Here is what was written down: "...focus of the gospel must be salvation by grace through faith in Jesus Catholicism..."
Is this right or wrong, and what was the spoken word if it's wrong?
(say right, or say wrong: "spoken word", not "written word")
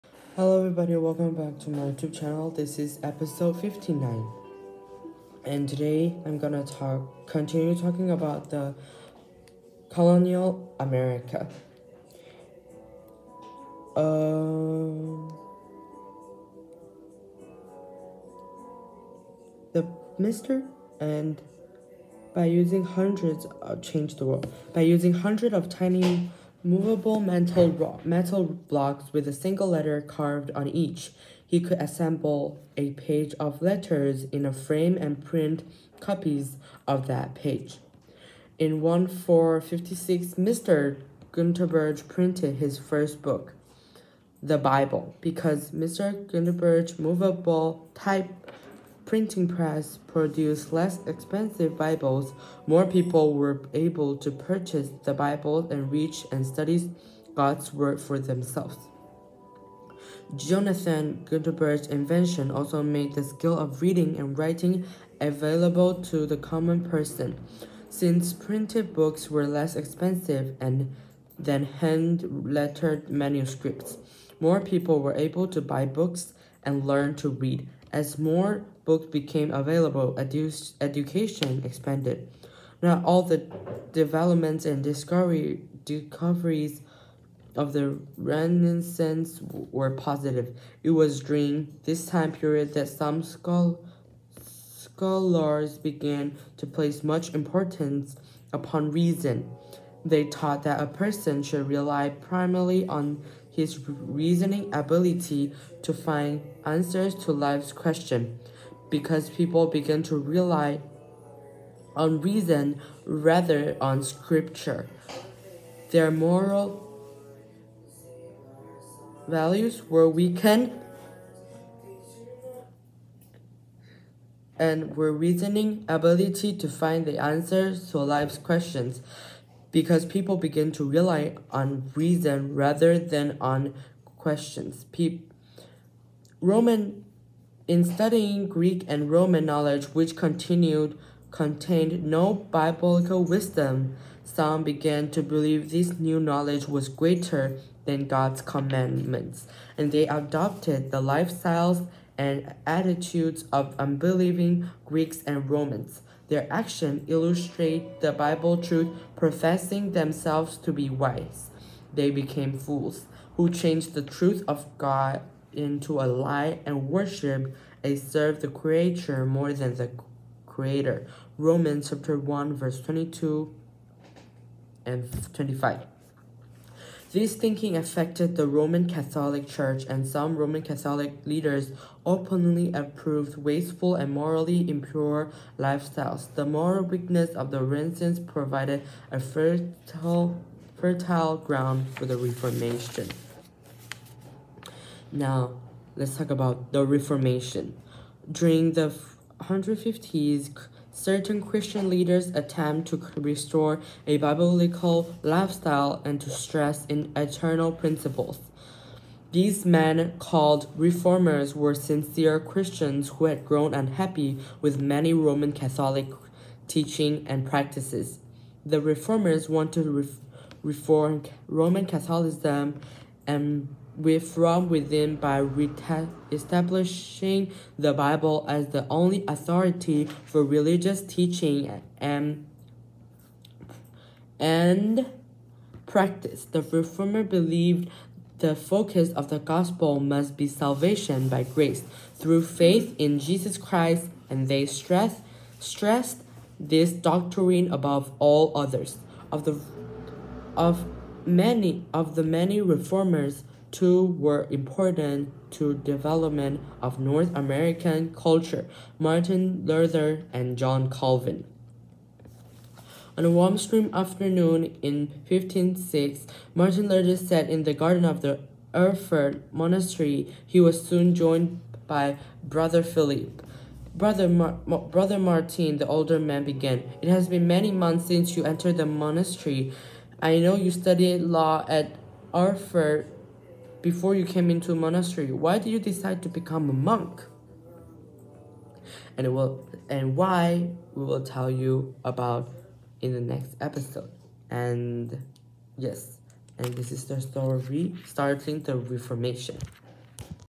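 wrong: "Christ", not "Catholicism".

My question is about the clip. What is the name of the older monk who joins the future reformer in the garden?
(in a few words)
Brother Philip.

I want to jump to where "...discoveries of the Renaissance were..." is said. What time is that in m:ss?
1:25.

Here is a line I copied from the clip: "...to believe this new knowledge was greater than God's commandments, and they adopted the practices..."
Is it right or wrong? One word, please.
wrong.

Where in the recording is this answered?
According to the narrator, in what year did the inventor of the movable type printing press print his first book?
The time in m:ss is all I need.
0:38.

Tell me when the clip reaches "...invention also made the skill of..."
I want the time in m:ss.
1:01.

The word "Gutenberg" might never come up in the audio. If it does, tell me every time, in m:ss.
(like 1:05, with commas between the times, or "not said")
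0:41, 1:01.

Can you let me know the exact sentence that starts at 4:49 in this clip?
And will and why we will tell you about in the next episode.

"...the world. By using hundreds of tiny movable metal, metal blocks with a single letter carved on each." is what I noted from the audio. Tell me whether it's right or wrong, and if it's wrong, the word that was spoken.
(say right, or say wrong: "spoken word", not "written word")
right.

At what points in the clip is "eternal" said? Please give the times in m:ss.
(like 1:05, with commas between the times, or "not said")
3:27.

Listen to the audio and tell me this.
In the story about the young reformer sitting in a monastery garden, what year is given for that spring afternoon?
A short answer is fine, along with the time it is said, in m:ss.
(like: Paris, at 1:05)
1506, at 4:25.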